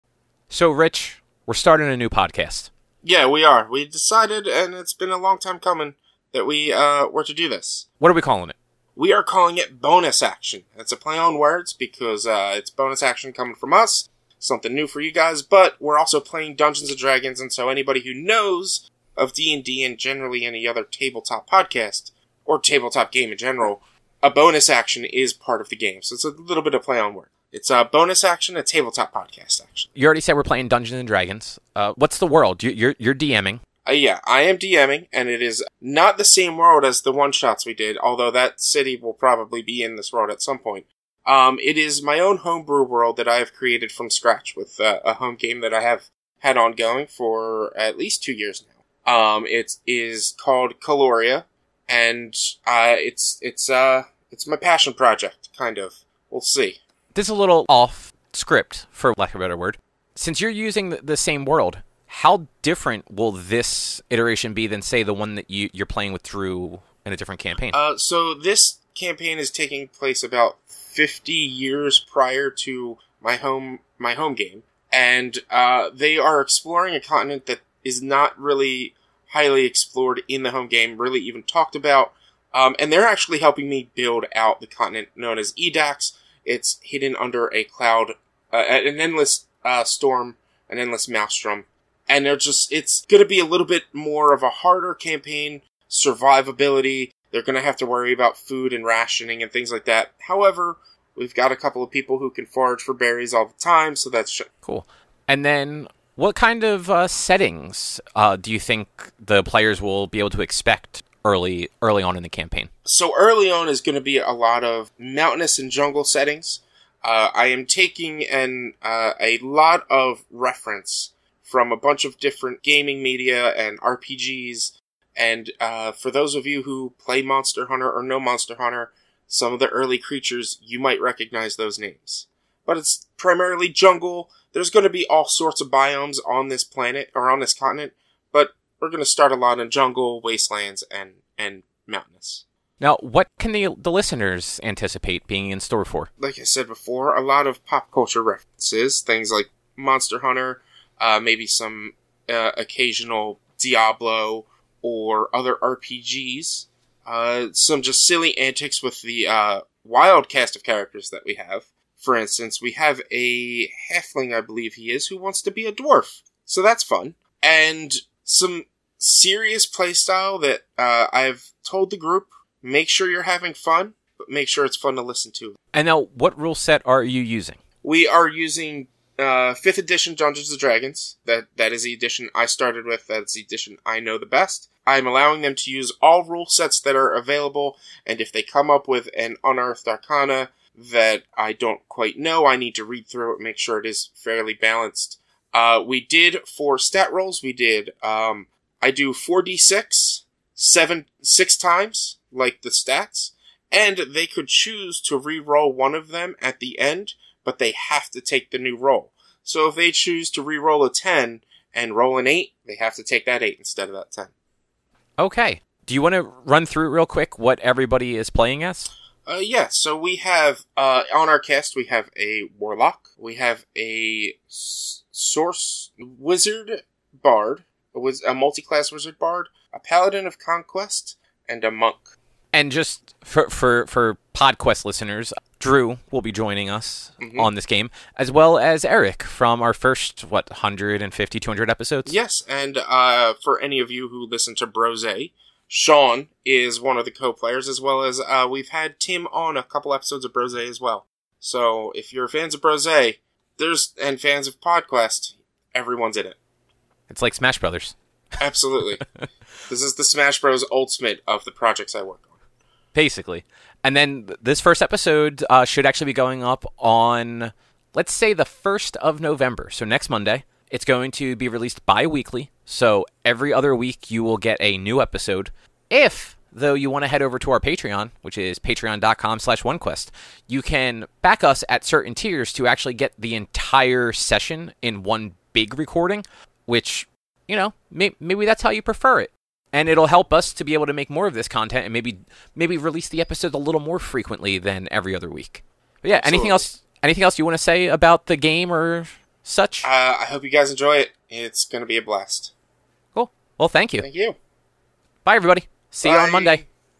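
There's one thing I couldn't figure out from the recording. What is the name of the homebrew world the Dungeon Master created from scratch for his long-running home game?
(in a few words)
Caloria.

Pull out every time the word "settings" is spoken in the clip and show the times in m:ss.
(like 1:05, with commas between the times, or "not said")
1:47, 1:56.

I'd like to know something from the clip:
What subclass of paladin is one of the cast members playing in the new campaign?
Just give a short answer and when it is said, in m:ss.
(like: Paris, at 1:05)
Conquest, at 3:50.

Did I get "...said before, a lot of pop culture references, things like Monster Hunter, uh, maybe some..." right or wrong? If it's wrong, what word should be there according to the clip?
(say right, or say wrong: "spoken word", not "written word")
right.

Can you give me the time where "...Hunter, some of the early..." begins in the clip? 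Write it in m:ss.
2:08.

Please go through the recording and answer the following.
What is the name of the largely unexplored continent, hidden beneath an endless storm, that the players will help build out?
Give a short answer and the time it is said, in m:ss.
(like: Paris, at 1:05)
Edax, at 1:25.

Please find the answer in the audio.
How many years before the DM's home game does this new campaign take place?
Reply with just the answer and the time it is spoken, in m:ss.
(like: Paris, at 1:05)
50, at 1:10.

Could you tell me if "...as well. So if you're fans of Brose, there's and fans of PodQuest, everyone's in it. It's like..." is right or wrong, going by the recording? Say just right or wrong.
right.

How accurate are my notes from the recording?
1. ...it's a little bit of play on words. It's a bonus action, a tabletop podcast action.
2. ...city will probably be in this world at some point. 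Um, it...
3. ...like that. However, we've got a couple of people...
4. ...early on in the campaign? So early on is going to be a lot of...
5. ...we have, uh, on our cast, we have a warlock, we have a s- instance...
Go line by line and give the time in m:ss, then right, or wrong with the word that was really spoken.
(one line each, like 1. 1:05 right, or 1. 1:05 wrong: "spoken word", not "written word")
1. 0:26 right
2. 0:38 right
3. 1:39 right
4. 1:51 right
5. 3:39 wrong: "source", not "instance".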